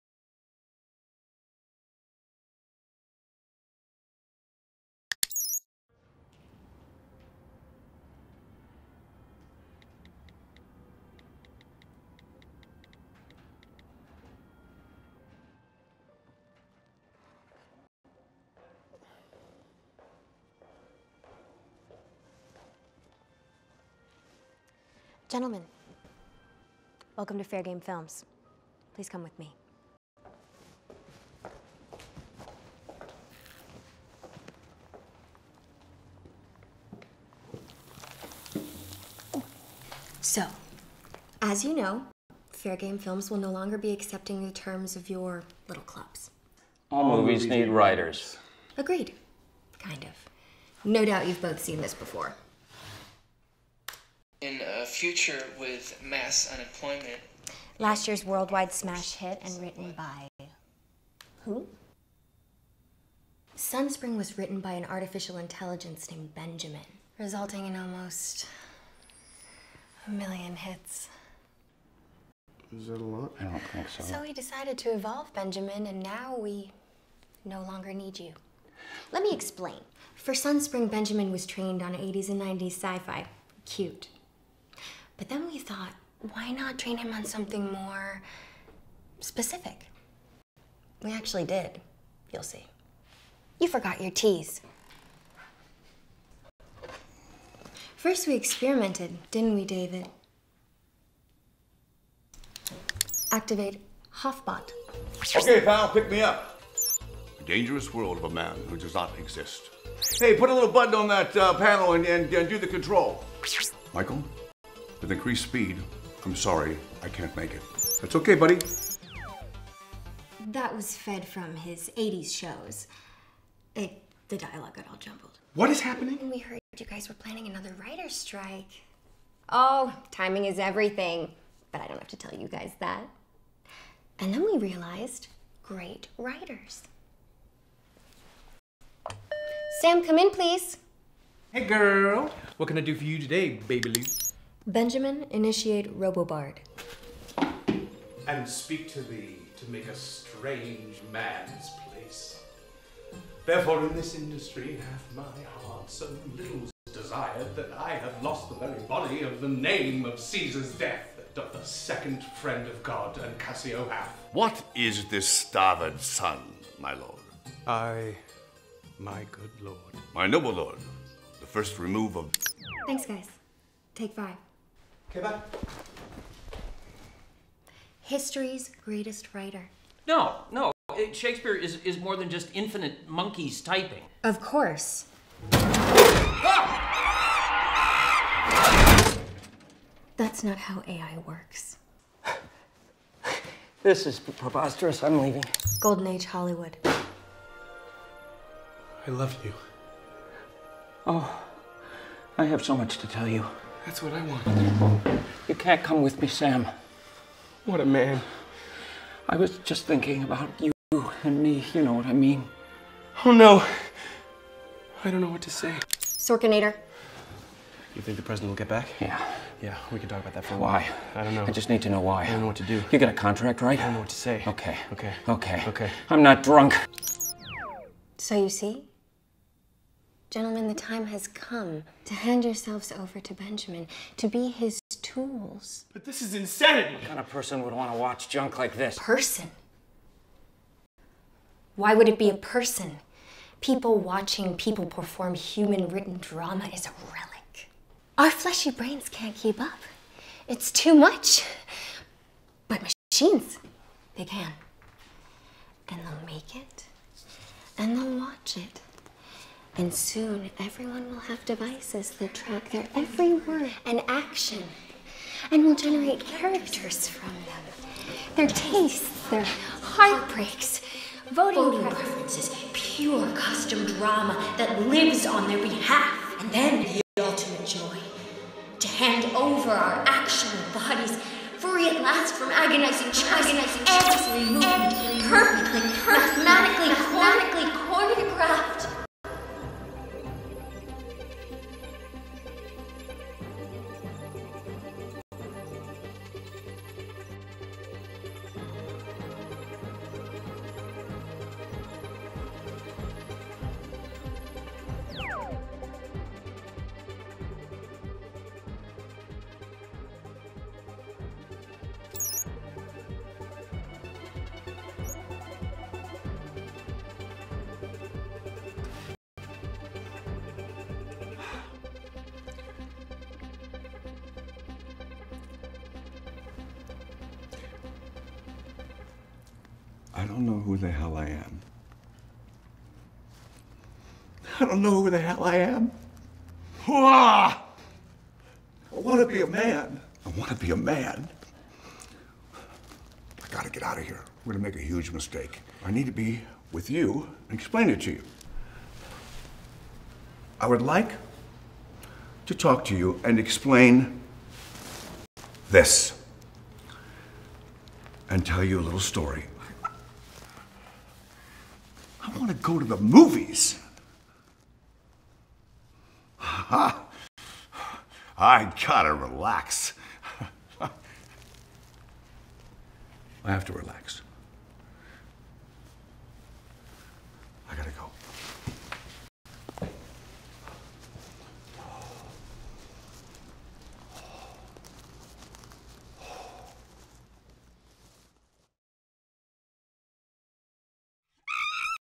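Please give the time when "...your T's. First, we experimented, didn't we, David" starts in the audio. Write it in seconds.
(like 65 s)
94 s.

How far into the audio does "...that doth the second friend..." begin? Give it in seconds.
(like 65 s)
161 s.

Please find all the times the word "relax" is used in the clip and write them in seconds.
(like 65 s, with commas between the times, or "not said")
369 s, 373 s.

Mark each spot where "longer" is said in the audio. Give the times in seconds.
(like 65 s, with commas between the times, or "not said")
43 s, 77 s.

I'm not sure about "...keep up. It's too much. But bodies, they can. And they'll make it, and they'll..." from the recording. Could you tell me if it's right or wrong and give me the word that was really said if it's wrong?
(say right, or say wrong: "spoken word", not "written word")
wrong: "machines", not "bodies".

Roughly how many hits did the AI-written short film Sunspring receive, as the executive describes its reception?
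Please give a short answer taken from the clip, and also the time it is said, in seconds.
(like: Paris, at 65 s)
almost a million, at 67 s.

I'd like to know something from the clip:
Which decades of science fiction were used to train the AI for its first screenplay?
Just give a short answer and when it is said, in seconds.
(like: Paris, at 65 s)
80s and 90s, at 81 s.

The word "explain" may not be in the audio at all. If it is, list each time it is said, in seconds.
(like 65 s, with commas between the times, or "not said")
79 s, 347 s, 353 s.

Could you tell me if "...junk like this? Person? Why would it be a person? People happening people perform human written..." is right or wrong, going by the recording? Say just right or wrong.
wrong.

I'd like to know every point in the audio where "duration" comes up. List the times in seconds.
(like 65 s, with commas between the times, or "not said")
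not said.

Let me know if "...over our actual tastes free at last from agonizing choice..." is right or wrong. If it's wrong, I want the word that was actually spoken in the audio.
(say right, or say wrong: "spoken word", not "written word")
wrong: "bodies", not "tastes".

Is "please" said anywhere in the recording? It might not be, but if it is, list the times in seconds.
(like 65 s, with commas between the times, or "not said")
28 s, 140 s.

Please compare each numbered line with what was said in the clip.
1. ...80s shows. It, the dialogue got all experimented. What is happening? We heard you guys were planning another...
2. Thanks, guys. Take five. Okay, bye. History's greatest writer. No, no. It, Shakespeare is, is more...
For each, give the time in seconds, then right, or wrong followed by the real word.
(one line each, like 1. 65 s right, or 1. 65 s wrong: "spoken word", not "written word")
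1. 121 s wrong: "jumbled", not "experimented"
2. 172 s right.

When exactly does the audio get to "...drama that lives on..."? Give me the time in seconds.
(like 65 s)
273 s.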